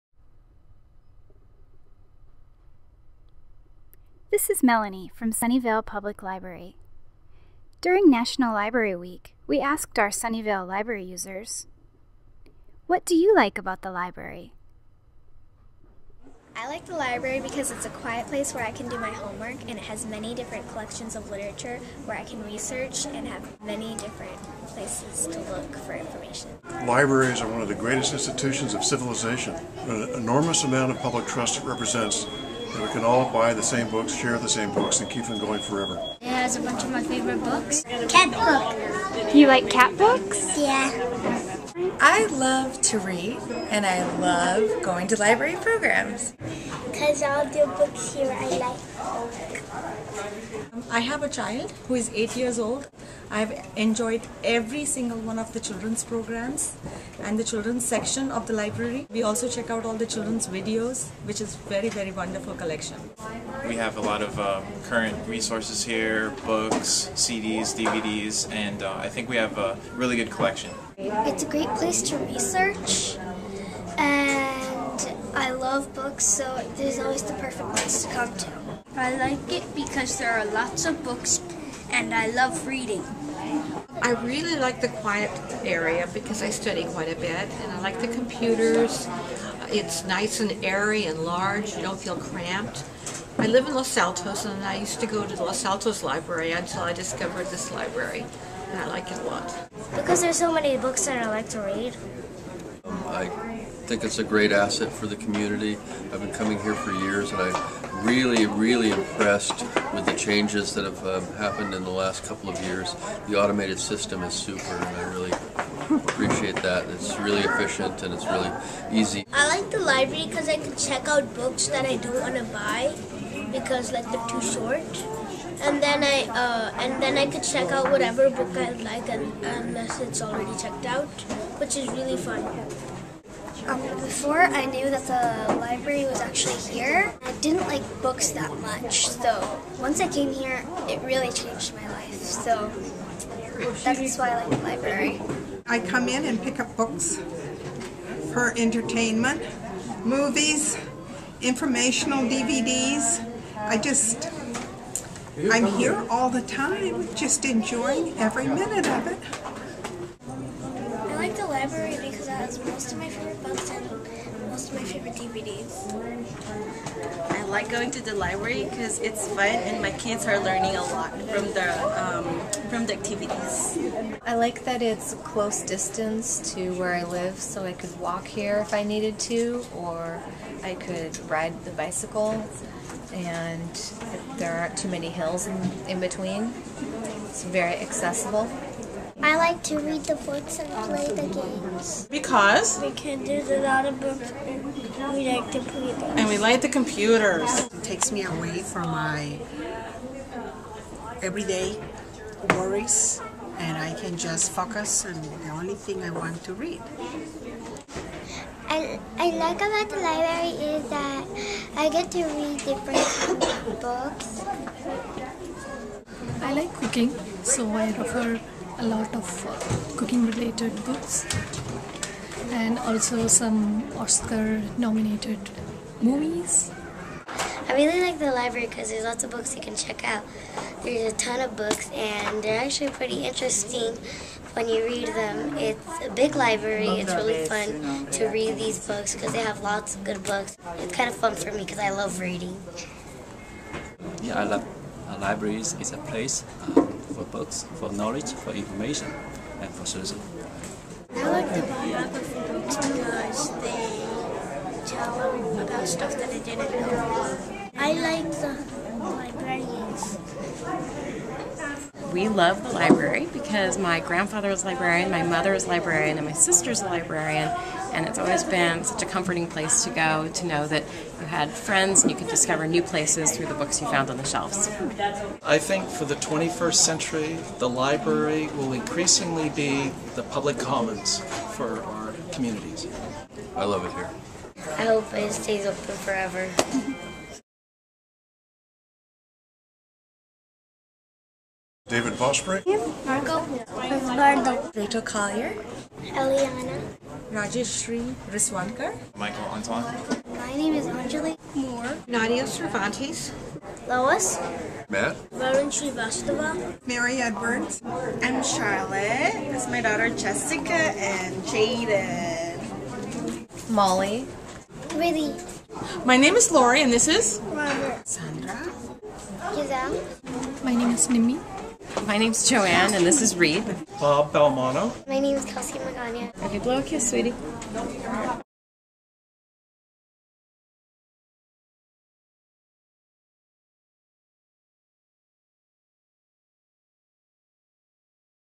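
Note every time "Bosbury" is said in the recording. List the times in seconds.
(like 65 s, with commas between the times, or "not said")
292 s.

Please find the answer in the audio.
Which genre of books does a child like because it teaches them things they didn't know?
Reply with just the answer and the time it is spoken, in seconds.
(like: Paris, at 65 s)
Biography, at 251 s.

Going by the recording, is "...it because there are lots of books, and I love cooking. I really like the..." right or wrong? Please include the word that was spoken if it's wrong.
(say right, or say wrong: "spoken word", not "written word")
wrong: "reading", not "cooking".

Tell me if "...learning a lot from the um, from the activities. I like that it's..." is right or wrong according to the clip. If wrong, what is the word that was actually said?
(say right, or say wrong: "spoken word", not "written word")
right.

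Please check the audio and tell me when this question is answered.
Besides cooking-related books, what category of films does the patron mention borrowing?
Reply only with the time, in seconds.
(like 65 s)
223 s.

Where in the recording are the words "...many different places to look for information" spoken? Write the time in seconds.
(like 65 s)
23 s.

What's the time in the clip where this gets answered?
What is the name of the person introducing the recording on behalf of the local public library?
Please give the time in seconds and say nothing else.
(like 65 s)
4 s.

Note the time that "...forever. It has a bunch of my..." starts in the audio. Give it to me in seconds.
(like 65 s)
35 s.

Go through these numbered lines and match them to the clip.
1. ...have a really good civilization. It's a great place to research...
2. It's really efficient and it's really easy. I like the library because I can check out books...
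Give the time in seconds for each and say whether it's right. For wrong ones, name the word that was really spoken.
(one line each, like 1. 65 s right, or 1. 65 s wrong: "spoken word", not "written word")
1. 69 s wrong: "collection", not "civilization"
2. 116 s right.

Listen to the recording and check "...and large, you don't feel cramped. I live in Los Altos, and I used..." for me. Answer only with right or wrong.
right.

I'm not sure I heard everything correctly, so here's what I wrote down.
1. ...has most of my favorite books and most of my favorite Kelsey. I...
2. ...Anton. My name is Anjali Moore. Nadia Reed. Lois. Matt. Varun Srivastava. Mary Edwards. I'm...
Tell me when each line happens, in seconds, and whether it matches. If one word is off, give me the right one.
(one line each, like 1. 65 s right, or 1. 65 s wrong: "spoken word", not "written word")
1. 162 s wrong: "DVDs", not "Kelsey"
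2. 299 s wrong: "Cervantes", not "Reed".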